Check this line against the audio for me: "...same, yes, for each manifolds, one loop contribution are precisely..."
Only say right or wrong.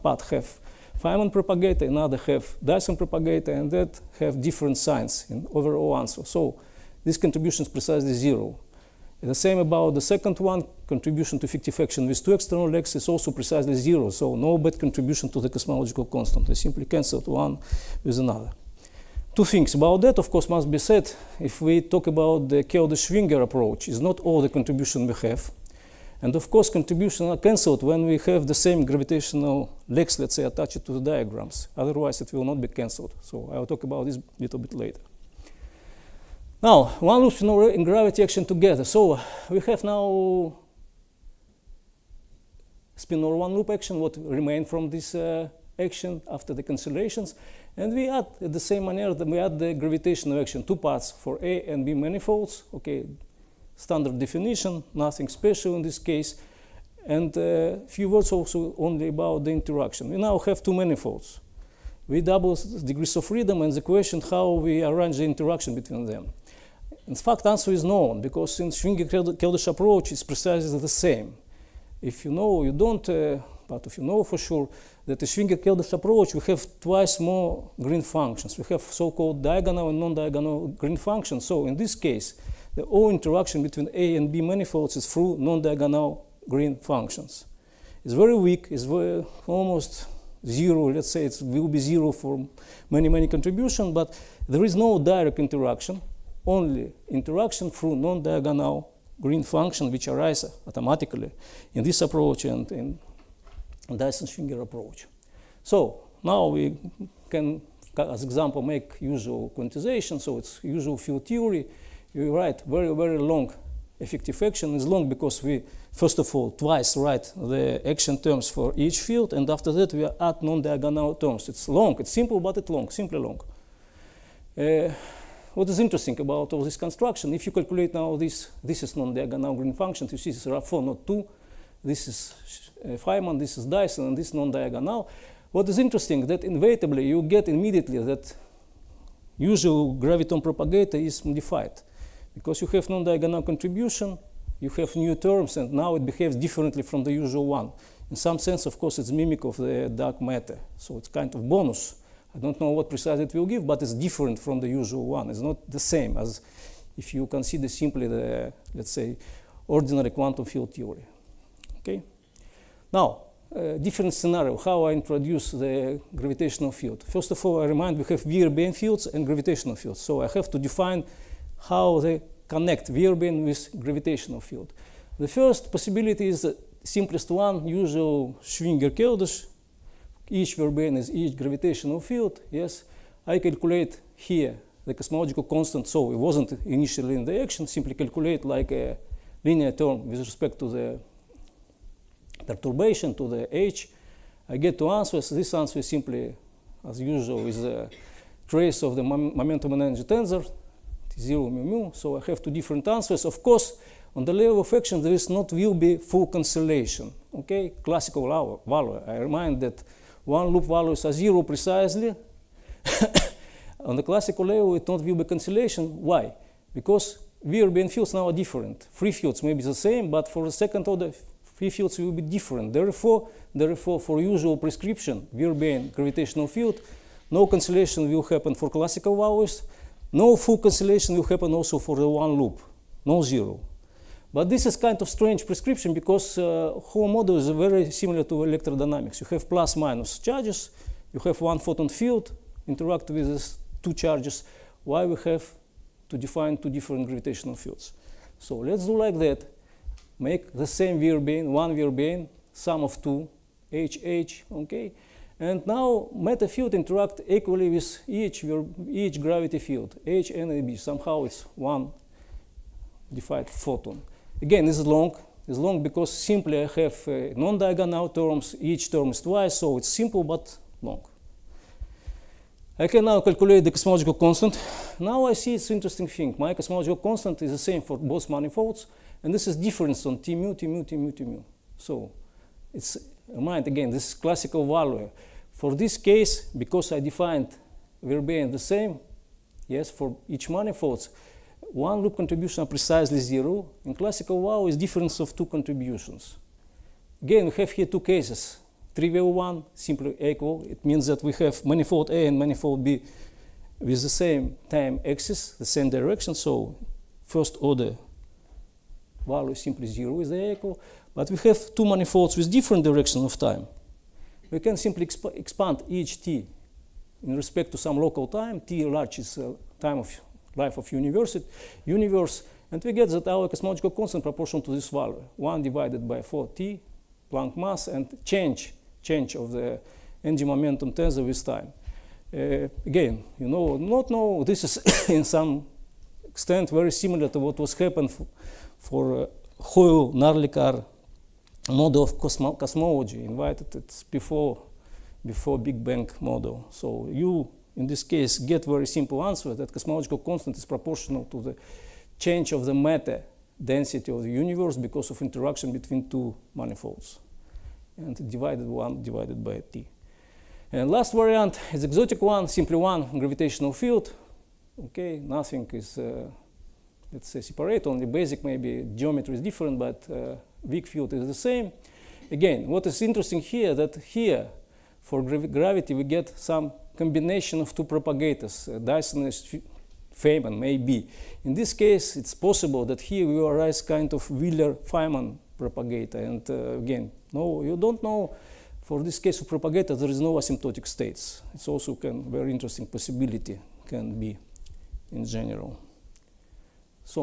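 right.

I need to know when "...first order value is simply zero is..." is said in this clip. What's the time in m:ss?
5:07.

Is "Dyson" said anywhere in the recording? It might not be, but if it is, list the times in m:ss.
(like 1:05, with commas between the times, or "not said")
0:02, 1:43, 2:13, 6:18.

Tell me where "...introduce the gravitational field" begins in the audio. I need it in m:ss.
2:44.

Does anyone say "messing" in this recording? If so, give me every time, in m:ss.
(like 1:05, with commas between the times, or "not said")
not said.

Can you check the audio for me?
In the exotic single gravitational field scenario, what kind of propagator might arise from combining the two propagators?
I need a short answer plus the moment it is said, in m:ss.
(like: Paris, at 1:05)
Wheeler-Feynman propagator, at 6:24.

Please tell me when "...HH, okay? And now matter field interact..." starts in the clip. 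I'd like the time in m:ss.
4:13.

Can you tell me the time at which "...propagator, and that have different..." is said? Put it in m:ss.
0:02.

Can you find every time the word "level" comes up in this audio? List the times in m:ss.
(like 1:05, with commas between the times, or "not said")
3:24, 3:34.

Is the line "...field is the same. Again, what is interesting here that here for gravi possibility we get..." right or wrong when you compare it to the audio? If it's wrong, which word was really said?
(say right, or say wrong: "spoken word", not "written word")
wrong: "gravity", not "possibility".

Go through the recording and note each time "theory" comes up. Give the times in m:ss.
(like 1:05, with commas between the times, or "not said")
1:51, 2:40.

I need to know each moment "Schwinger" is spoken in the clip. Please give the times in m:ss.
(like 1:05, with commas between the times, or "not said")
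0:23, 1:08, 1:15, 1:43, 2:58.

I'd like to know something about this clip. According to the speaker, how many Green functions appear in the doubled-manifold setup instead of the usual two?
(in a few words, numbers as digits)
4.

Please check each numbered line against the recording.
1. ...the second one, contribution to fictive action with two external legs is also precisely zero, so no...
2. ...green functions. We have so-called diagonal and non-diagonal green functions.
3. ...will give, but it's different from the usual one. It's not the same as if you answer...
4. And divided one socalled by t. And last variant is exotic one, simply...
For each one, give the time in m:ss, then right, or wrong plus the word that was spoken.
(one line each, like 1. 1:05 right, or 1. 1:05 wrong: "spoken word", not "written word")
1. 0:09 right
2. 1:17 right
3. 2:33 wrong: "consider", not "answer"
4. 5:57 wrong: "divided", not "socalled".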